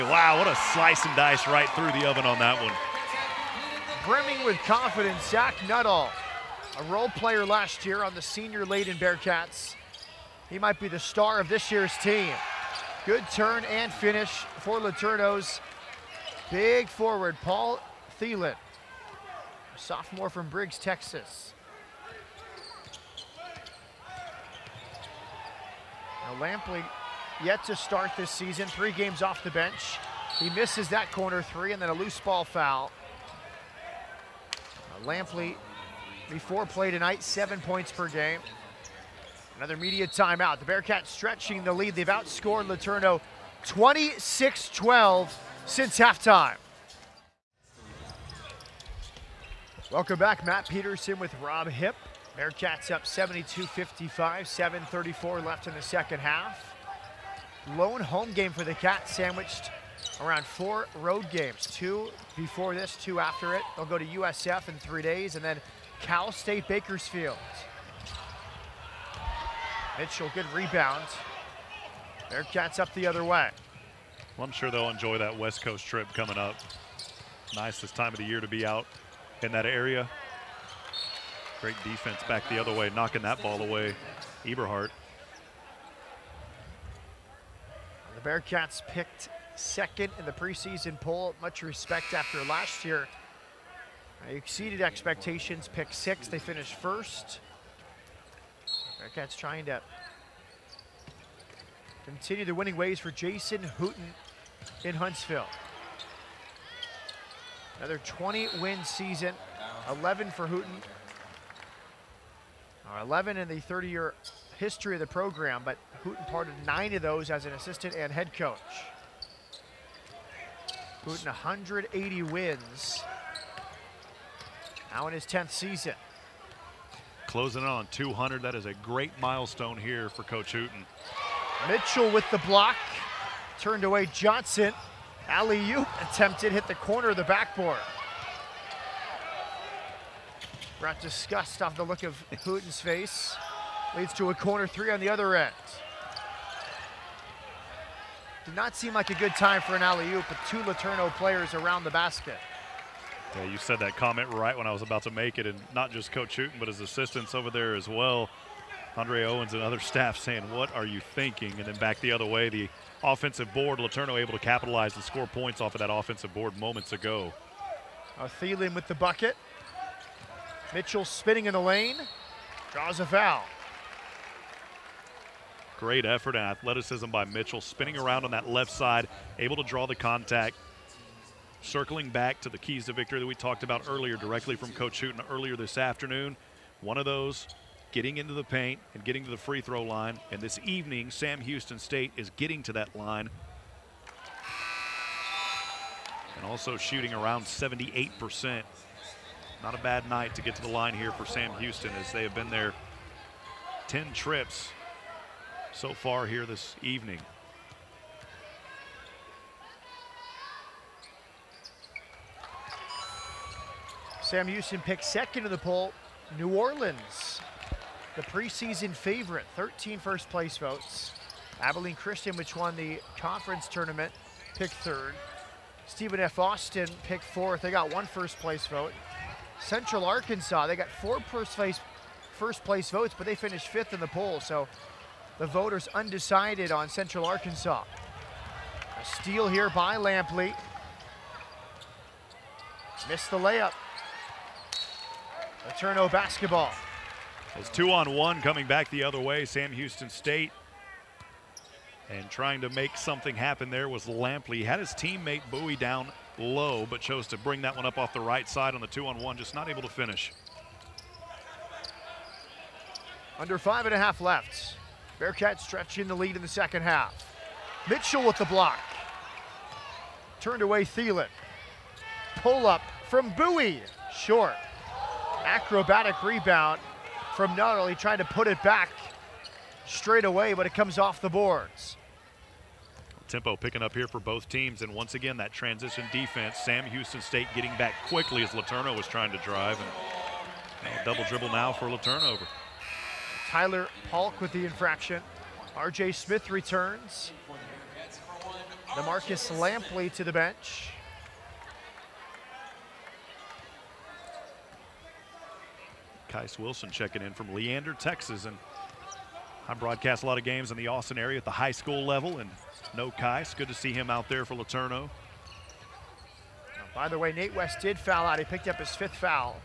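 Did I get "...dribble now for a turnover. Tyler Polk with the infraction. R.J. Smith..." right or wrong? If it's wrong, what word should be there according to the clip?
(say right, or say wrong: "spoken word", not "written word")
right.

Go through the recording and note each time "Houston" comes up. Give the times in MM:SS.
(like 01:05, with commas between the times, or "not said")
03:11, 03:21, 03:34, 04:09, 04:46.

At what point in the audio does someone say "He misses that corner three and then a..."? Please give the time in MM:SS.
00:30.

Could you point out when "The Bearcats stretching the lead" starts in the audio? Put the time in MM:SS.
00:40.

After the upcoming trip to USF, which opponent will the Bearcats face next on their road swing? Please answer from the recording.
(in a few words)
Cal State Bakersfield.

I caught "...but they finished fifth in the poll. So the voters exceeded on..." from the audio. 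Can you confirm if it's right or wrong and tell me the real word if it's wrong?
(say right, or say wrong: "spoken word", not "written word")
wrong: "undecided", not "exceeded".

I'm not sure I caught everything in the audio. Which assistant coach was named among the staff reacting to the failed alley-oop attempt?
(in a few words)
Andre Owens.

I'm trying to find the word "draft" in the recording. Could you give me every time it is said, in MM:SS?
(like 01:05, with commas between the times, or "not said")
not said.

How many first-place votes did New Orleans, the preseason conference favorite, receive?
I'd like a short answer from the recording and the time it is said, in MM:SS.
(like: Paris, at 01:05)
13, at 03:39.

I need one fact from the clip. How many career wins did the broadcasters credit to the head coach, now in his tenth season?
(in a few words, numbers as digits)
180.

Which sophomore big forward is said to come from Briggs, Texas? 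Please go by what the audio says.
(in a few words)
Paul Thielen.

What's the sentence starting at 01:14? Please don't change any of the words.
Well, I'm sure they'll enjoy that West Coast trip coming up.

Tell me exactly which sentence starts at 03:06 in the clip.
One of those, getting into the paint and getting to the free throw line.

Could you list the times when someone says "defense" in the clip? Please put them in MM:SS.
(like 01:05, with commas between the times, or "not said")
01:21, 04:46.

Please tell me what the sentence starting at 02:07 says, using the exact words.
Closing on 200, that is a great milestone here for Coach Hooten.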